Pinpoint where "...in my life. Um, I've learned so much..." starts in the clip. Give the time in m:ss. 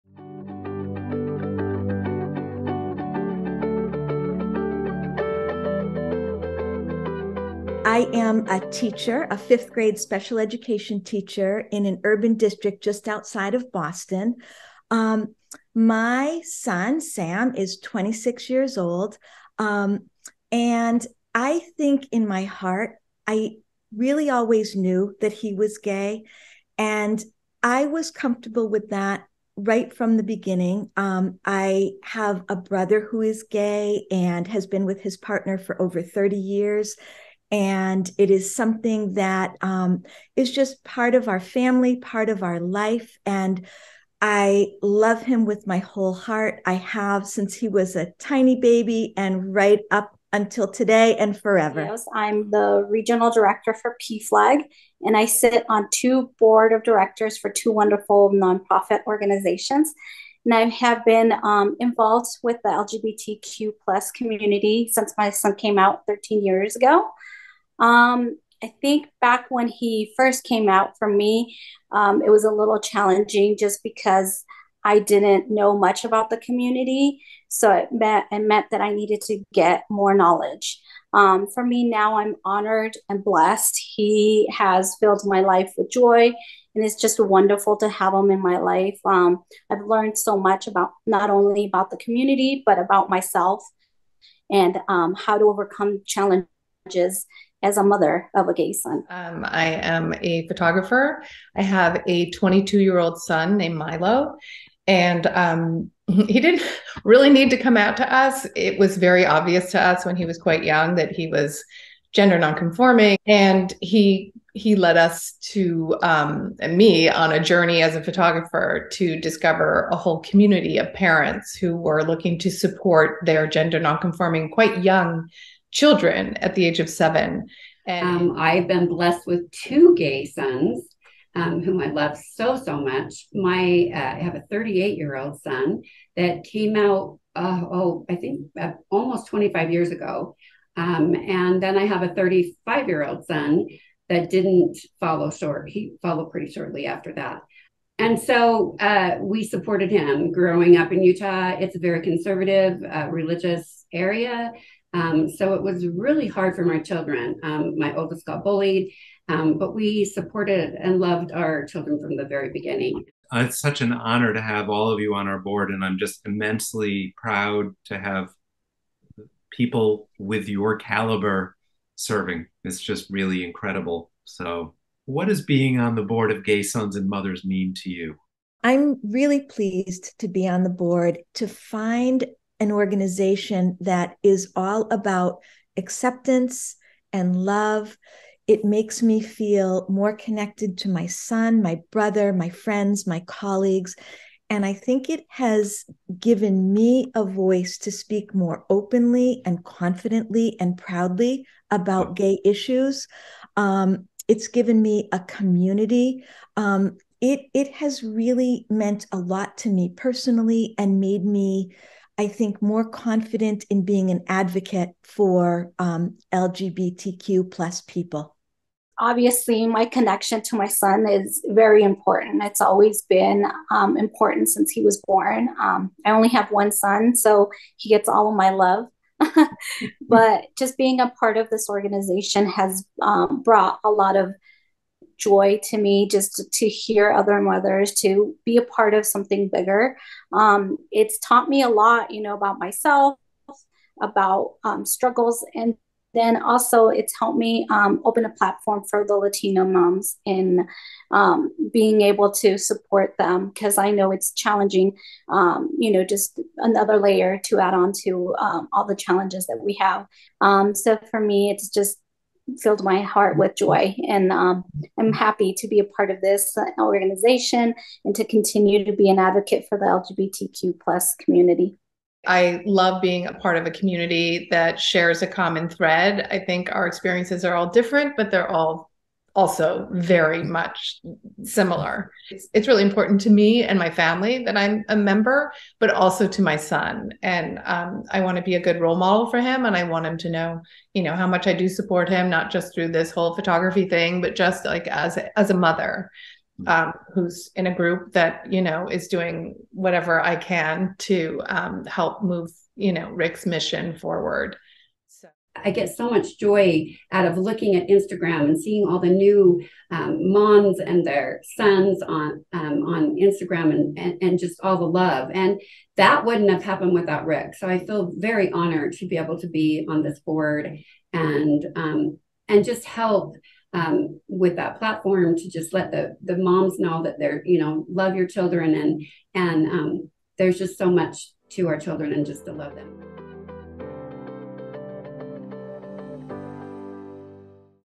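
1:28.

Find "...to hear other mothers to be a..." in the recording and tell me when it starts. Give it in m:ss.
3:56.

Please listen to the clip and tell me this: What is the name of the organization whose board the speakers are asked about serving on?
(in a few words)
Gay Sons and Mothers.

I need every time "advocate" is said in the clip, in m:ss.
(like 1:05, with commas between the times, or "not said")
3:34, 4:29.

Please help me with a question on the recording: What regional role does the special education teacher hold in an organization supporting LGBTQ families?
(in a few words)
Regional director for PFLAG.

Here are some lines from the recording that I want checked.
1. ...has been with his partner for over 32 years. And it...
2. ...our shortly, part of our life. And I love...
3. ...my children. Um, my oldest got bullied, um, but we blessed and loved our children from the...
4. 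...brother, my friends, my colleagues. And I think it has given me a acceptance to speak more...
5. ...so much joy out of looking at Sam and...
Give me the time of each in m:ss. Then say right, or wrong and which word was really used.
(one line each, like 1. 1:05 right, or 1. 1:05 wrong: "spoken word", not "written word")
1. 0:34 wrong: "30", not "32"
2. 0:41 wrong: "family", not "shortly"
3. 2:36 wrong: "supported", not "blessed"
4. 3:11 wrong: "voice", not "acceptance"
5. 5:05 wrong: "Instagram", not "Sam".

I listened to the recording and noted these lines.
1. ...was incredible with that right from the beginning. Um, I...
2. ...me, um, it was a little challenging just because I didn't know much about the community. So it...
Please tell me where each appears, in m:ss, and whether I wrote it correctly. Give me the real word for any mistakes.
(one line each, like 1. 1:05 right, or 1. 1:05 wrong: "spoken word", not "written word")
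1. 0:27 wrong: "comfortable", not "incredible"
2. 1:11 right.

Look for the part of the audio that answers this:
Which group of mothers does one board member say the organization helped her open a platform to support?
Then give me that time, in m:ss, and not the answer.
4:09.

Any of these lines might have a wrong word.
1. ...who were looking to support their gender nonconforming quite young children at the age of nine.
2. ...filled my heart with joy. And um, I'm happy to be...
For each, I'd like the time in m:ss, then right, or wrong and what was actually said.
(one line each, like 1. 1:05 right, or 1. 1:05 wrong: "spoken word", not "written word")
1. 2:01 wrong: "seven", not "nine"
2. 4:22 right.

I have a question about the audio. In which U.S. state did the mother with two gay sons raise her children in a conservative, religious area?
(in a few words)
Utah.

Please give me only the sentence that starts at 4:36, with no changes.
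I think our experiences are all different, but they're all also very much similar.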